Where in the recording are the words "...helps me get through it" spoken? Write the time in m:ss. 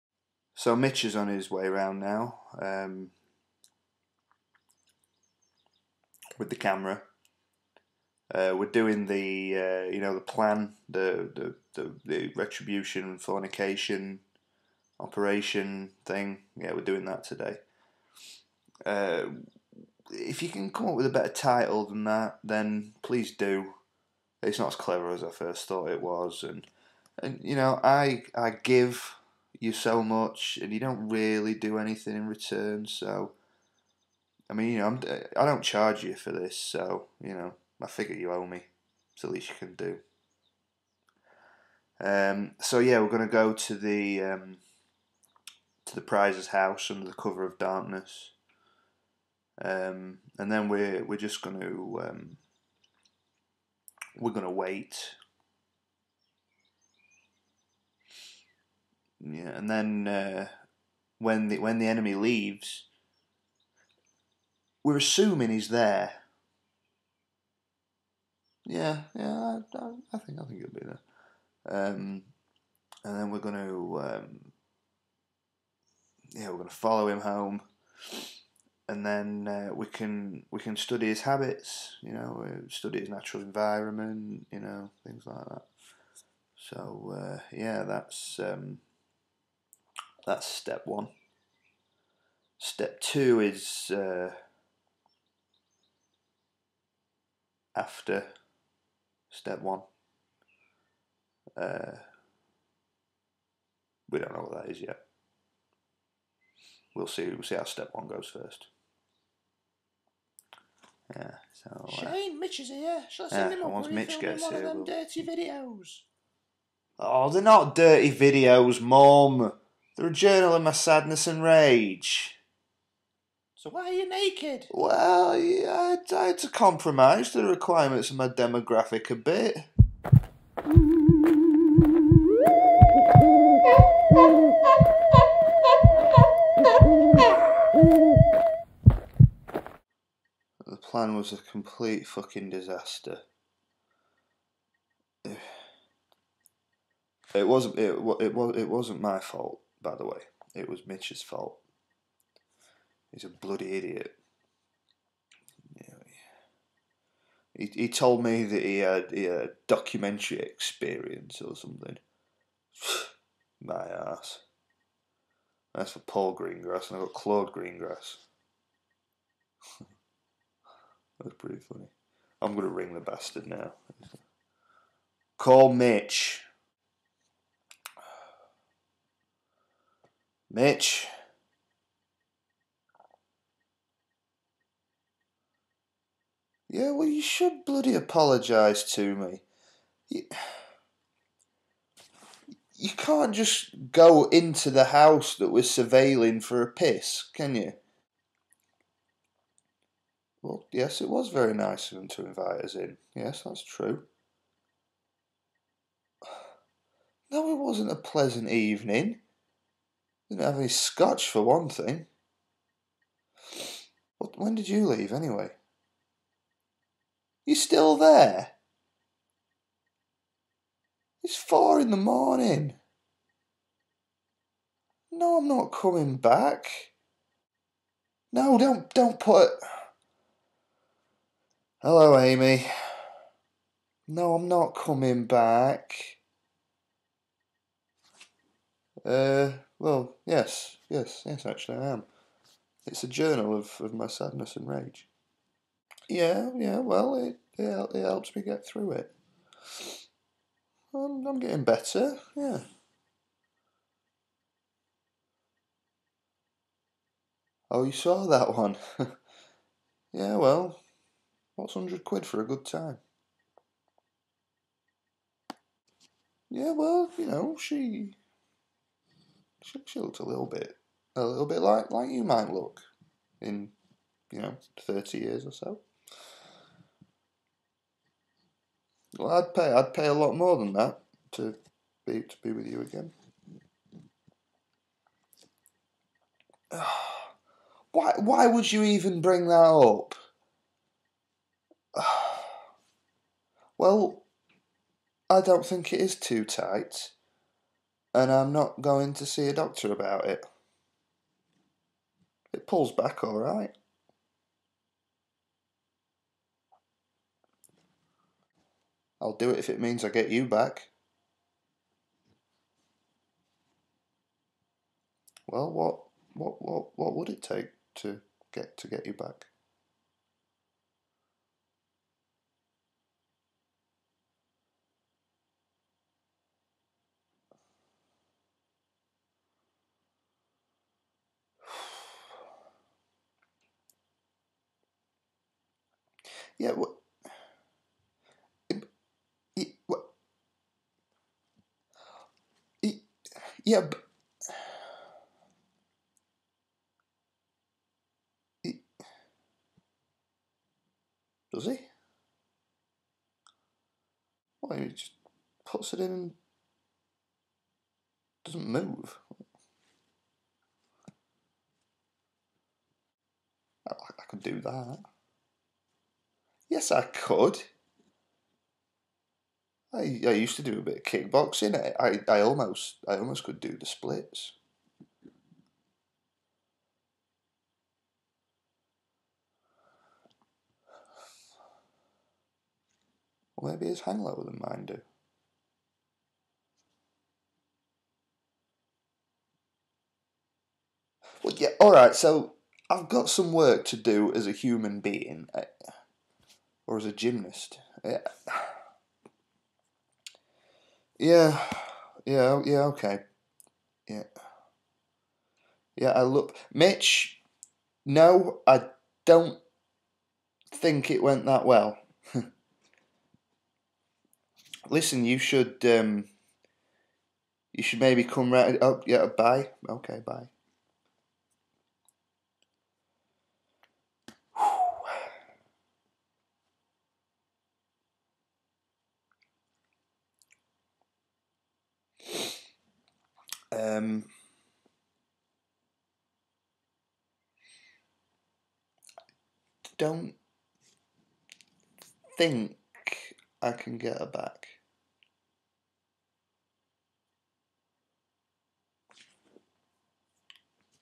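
4:08.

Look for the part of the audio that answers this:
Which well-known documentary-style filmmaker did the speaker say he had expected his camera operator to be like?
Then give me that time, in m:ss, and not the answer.
2:45.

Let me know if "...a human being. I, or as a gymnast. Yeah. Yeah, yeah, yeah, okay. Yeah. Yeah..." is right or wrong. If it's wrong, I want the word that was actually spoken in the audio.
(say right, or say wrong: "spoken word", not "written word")
right.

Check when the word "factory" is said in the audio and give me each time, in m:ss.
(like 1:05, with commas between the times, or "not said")
not said.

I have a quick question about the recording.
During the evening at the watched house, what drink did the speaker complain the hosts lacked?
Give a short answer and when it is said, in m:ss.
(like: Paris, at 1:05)
scotch, at 3:30.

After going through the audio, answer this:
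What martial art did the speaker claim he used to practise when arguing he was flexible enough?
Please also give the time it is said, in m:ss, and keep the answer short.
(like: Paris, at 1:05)
kickboxing, at 6:11.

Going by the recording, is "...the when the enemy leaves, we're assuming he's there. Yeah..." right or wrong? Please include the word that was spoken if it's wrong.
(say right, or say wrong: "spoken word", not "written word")
right.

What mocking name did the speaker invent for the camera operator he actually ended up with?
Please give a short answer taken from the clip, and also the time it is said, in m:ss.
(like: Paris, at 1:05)
Claude Greengrass, at 2:47.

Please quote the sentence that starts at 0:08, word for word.
Uh, we're doing the uh, you know the plan, the, the the, the retribution, fornication, operation thing.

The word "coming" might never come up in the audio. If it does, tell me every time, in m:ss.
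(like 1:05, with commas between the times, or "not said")
3:45, 3:54.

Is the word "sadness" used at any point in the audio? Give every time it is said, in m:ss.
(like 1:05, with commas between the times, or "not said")
2:00, 4:04.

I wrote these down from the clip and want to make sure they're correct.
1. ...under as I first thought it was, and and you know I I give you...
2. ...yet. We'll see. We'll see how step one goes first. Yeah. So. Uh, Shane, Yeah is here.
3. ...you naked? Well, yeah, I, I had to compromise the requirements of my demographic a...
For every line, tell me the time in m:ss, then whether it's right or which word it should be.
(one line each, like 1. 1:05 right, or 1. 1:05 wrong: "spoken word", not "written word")
1. 0:24 wrong: "clever", not "under"
2. 1:44 wrong: "Mitch", not "Yeah"
3. 2:03 right.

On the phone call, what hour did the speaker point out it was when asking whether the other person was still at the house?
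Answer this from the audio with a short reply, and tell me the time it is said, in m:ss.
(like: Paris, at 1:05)
4 in the morning, at 3:41.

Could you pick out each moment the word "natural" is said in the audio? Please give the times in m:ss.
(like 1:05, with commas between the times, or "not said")
1:23.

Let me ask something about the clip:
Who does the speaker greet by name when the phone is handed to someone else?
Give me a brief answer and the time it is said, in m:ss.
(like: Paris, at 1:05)
Amy, at 3:52.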